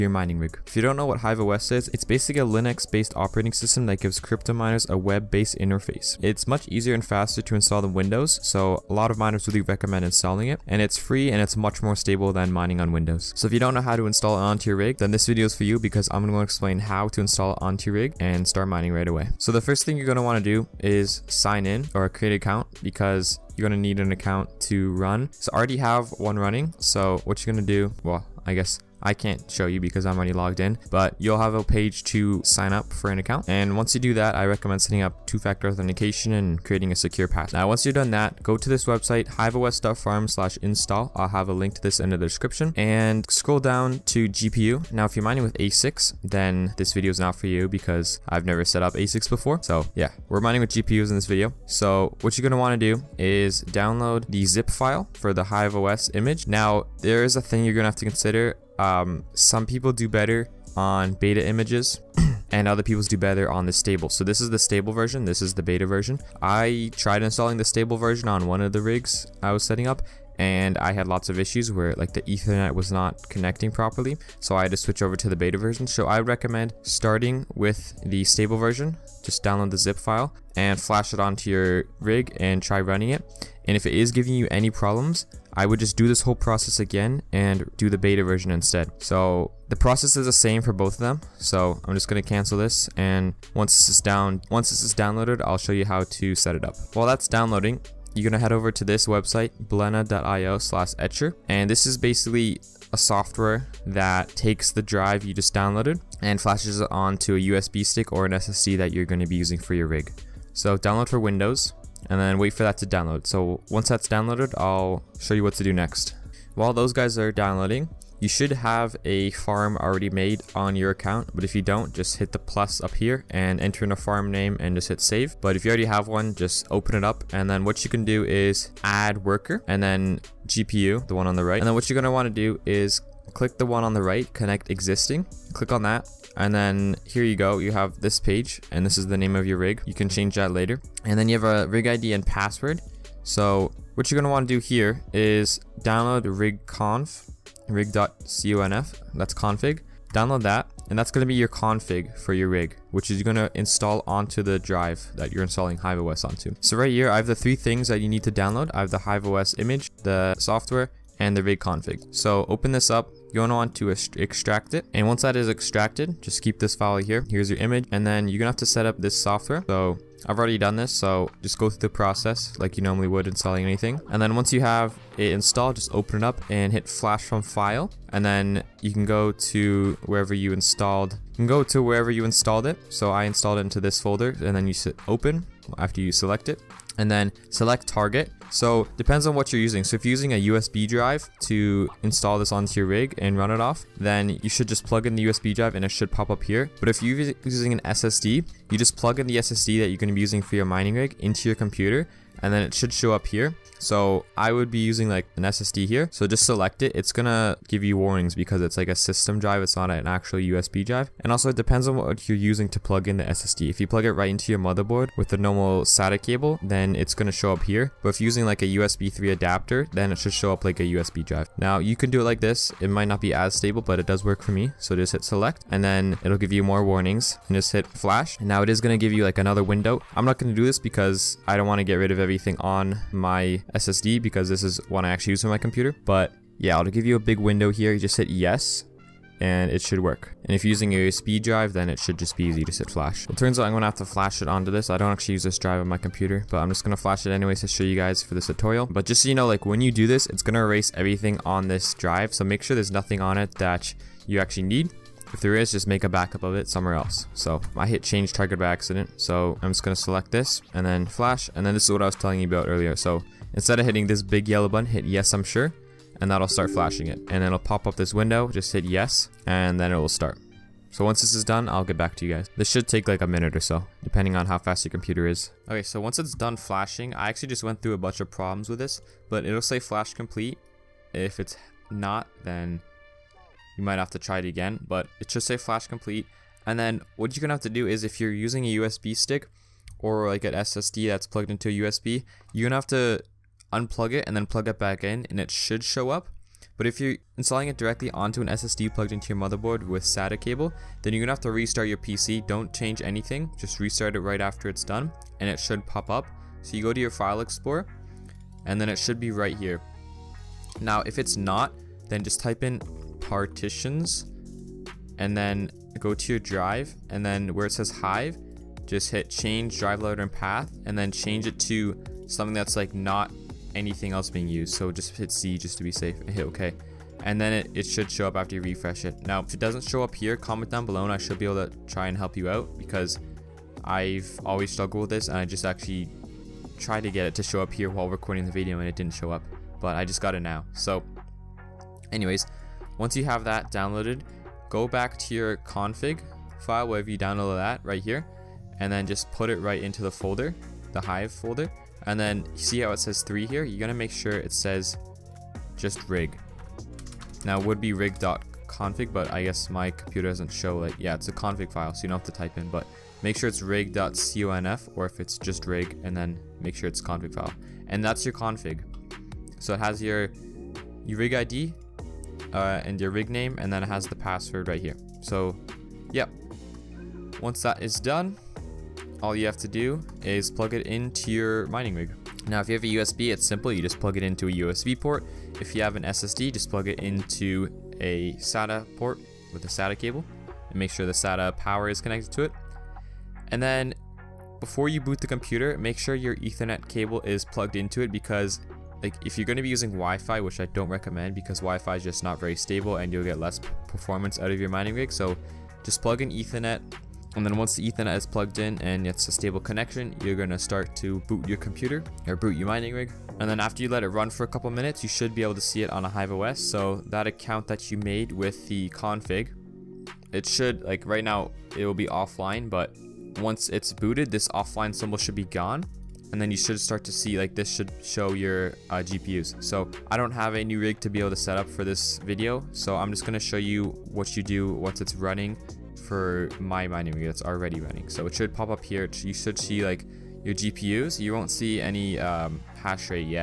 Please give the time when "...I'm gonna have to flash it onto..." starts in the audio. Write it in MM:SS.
04:03.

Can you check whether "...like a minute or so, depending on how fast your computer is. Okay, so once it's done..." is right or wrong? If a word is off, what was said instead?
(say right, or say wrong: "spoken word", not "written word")
right.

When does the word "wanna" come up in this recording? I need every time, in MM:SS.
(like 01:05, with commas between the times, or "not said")
02:12, 02:24.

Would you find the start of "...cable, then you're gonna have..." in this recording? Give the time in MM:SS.
05:00.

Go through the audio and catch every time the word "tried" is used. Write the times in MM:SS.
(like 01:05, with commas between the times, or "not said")
01:06, 05:36.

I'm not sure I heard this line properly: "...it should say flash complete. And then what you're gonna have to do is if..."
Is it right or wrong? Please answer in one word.
right.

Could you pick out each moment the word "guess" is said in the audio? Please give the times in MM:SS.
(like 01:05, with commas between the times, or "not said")
00:28, 05:59.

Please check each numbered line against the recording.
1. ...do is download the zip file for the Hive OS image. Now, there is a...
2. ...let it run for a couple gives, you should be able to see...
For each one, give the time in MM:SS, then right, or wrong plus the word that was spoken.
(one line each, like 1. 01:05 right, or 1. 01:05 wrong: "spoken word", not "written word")
1. 00:52 right
2. 06:53 wrong: "minutes", not "gives".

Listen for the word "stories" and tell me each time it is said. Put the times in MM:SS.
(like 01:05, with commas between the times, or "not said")
not said.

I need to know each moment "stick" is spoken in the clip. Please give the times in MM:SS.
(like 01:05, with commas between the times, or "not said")
01:47, 04:49.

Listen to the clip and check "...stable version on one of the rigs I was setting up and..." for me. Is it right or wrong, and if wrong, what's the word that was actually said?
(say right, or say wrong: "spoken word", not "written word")
right.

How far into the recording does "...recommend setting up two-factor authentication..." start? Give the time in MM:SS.
00:34.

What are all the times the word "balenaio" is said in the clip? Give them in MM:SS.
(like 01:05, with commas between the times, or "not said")
01:39.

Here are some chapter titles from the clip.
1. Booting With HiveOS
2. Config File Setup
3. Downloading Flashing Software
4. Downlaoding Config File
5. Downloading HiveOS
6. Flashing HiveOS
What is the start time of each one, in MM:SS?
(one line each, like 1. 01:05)
1. 06:21
2. 05:40
3. 01:37
4. 01:56
5. 00:19
6. 02:37.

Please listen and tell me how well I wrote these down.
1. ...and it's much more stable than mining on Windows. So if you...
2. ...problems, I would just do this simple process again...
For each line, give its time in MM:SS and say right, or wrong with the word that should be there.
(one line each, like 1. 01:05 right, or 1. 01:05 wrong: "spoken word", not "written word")
1. 00:11 right
2. 01:24 wrong: "whole", not "simple".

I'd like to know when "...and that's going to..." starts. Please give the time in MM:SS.
02:30.